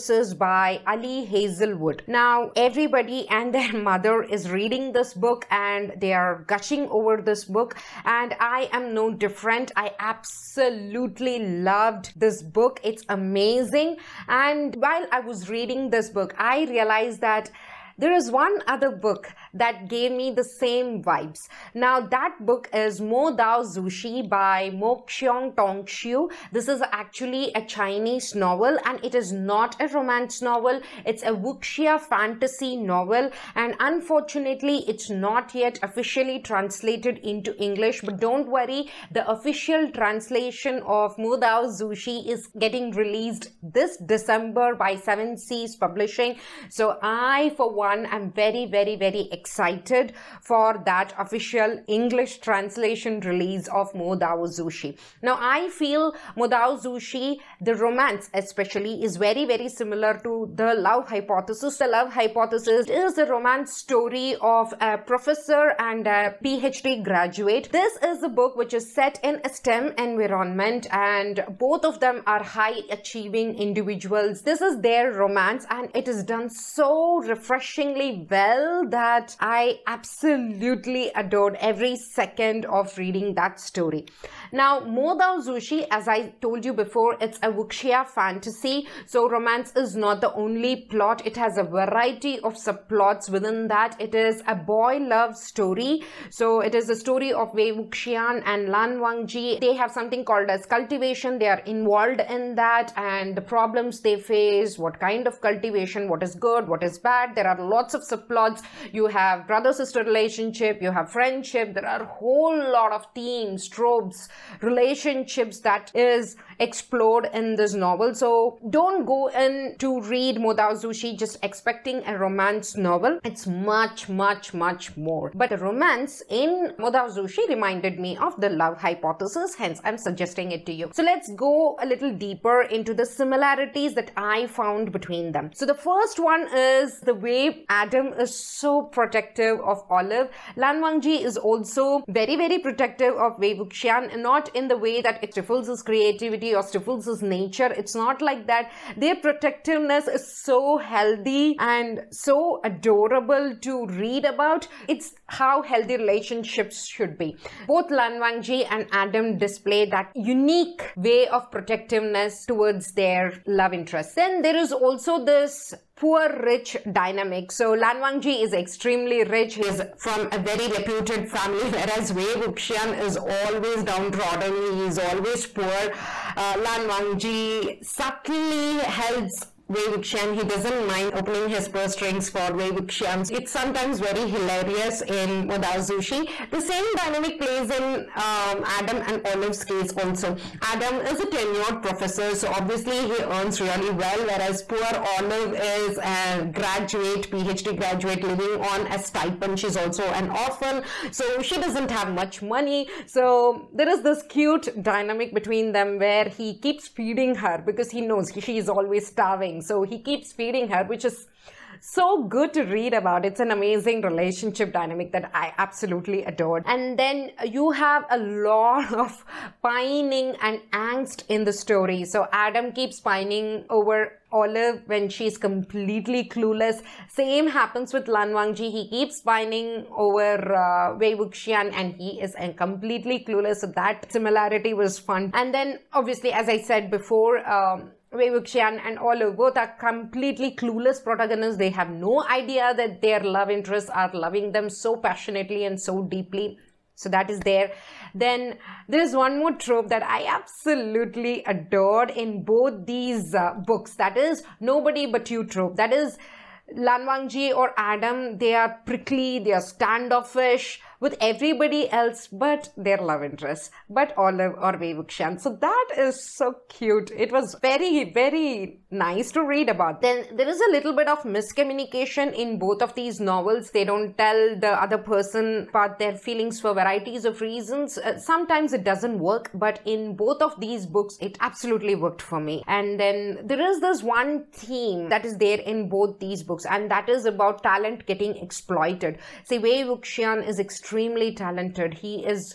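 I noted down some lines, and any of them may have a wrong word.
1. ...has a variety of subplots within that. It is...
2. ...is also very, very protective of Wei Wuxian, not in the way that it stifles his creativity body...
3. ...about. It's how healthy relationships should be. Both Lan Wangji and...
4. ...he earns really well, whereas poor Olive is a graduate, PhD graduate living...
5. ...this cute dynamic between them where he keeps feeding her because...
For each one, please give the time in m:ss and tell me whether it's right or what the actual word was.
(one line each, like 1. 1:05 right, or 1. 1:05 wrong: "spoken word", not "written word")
1. 1:31 right
2. 2:21 right
3. 2:34 right
4. 3:13 right
5. 3:24 right.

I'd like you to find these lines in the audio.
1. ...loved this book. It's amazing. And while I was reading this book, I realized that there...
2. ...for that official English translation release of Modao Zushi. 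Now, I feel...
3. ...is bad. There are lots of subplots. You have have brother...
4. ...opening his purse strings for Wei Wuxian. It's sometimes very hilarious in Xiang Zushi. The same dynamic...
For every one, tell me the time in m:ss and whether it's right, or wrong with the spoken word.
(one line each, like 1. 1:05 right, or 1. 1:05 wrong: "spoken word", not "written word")
1. 0:11 right
2. 0:50 right
3. 1:46 right
4. 3:01 wrong: "Modao", not "Xiang".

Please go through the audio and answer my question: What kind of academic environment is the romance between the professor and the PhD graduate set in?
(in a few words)
STEM.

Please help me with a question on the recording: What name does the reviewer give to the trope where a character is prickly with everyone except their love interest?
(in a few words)
Nobody but you.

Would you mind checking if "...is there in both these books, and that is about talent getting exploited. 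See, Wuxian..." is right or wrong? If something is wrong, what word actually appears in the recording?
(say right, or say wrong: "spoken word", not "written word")
right.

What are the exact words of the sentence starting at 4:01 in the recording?
They have no idea that their love interests are loving them so passionately and so deeply.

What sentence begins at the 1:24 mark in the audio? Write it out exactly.
Now, Mo Dao Zushi, as I told you before, it's a wuxia fantasy.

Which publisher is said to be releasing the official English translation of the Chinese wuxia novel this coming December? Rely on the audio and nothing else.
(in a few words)
7 Seas Publishing.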